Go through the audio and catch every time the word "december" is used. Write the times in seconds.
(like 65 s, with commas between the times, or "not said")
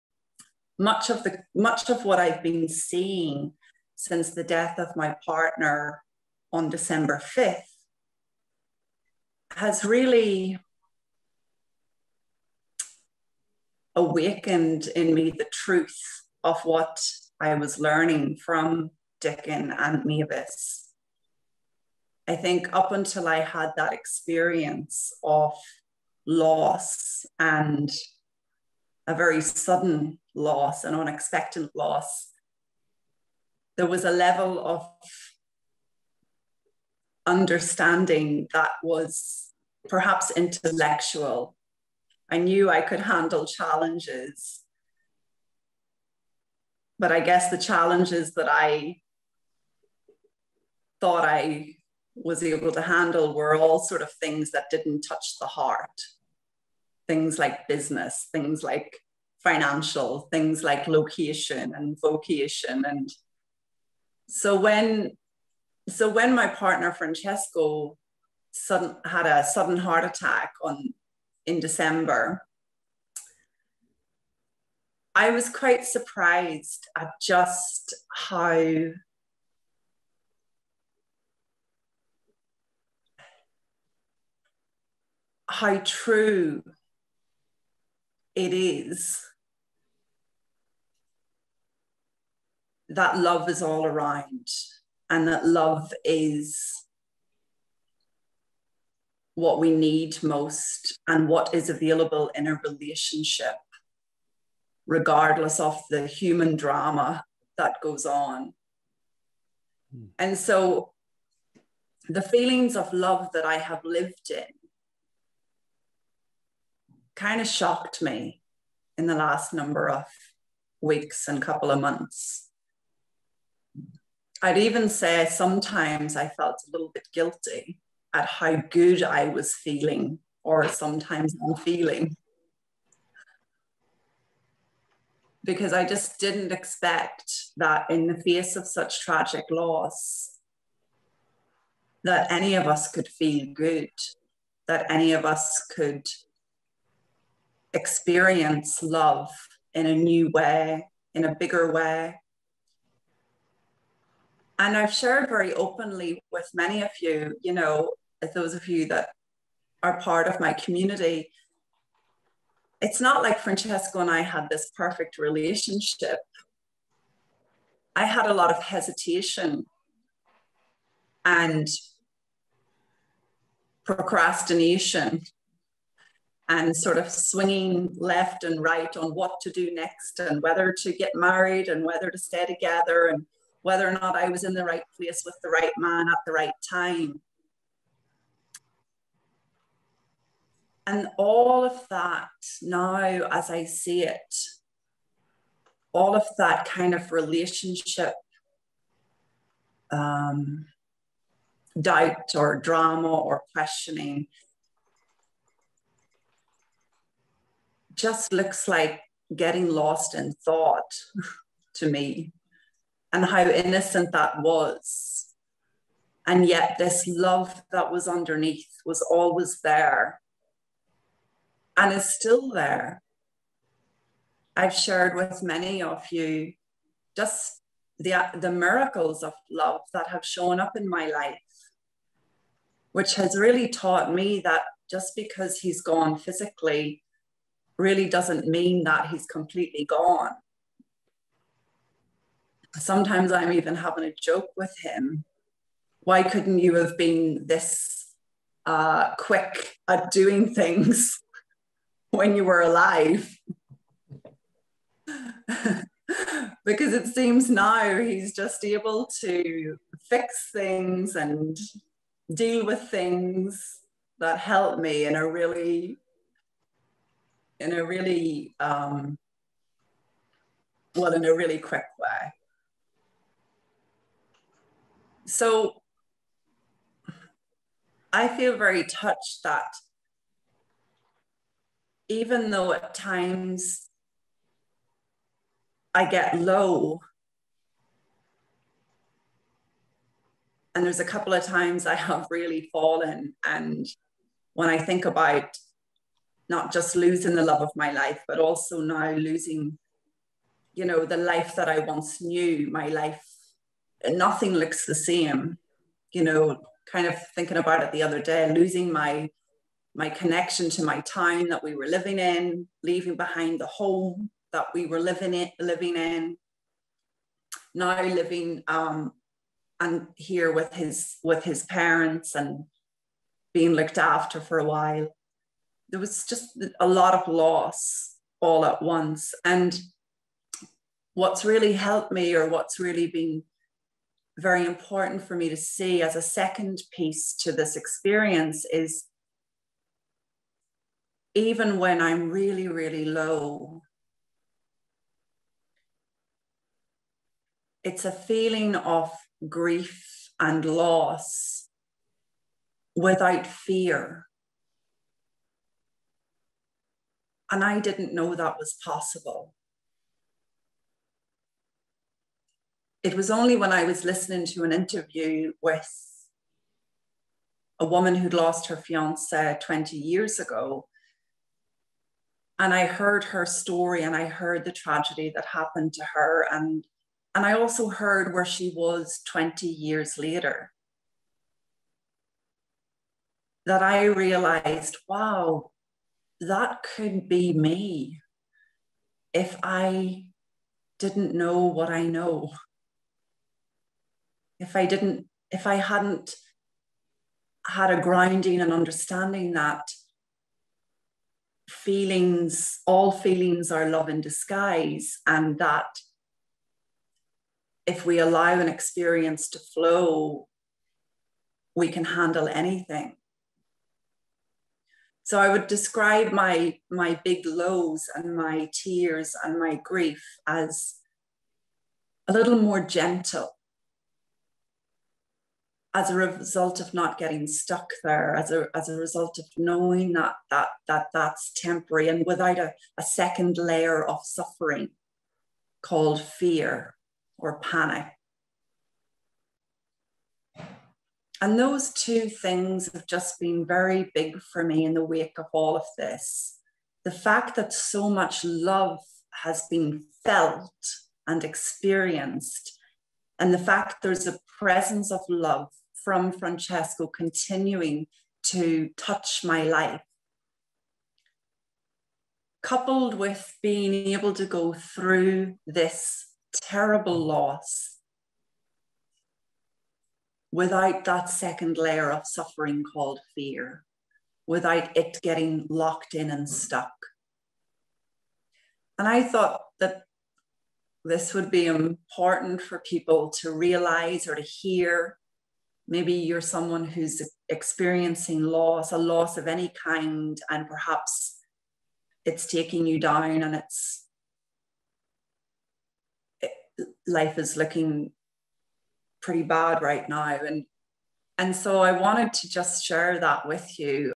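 6 s, 71 s.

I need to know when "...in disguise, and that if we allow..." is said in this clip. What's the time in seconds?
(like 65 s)
404 s.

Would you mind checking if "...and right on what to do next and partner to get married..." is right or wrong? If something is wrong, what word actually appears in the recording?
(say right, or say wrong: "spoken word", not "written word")
wrong: "whether", not "partner".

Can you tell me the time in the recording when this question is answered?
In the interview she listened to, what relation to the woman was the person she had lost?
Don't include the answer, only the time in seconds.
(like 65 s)
368 s.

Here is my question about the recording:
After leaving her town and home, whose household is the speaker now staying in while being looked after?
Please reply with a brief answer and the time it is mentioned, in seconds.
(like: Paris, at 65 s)
His parents, at 321 s.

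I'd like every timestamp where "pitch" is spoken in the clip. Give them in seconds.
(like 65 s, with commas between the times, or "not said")
not said.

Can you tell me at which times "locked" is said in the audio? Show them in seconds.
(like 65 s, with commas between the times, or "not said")
475 s.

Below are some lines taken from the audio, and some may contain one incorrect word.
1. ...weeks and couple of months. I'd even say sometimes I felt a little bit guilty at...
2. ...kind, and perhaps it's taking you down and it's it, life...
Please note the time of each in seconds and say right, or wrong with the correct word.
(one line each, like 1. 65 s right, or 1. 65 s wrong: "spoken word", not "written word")
1. 120 s right
2. 489 s right.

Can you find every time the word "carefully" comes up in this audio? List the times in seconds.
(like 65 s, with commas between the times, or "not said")
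not said.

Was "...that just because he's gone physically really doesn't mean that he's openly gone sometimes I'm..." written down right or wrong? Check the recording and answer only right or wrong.
wrong.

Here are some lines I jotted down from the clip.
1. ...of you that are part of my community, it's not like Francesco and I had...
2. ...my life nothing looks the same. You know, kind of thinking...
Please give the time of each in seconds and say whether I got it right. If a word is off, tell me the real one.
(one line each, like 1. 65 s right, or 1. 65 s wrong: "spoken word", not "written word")
1. 158 s right
2. 302 s right.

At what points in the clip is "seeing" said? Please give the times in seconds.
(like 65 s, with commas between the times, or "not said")
2 s.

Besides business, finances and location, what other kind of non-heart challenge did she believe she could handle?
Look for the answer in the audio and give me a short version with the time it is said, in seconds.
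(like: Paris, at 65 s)
Vocation, at 61 s.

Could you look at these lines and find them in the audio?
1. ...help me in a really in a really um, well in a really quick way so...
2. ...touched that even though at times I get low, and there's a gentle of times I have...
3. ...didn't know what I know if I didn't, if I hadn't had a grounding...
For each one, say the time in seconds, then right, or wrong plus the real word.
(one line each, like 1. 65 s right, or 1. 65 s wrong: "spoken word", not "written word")
1. 264 s right
2. 278 s wrong: "couple", not "gentle"
3. 390 s right.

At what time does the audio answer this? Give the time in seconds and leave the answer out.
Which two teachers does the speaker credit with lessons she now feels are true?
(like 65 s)
19 s.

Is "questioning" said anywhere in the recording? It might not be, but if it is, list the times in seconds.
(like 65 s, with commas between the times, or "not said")
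203 s.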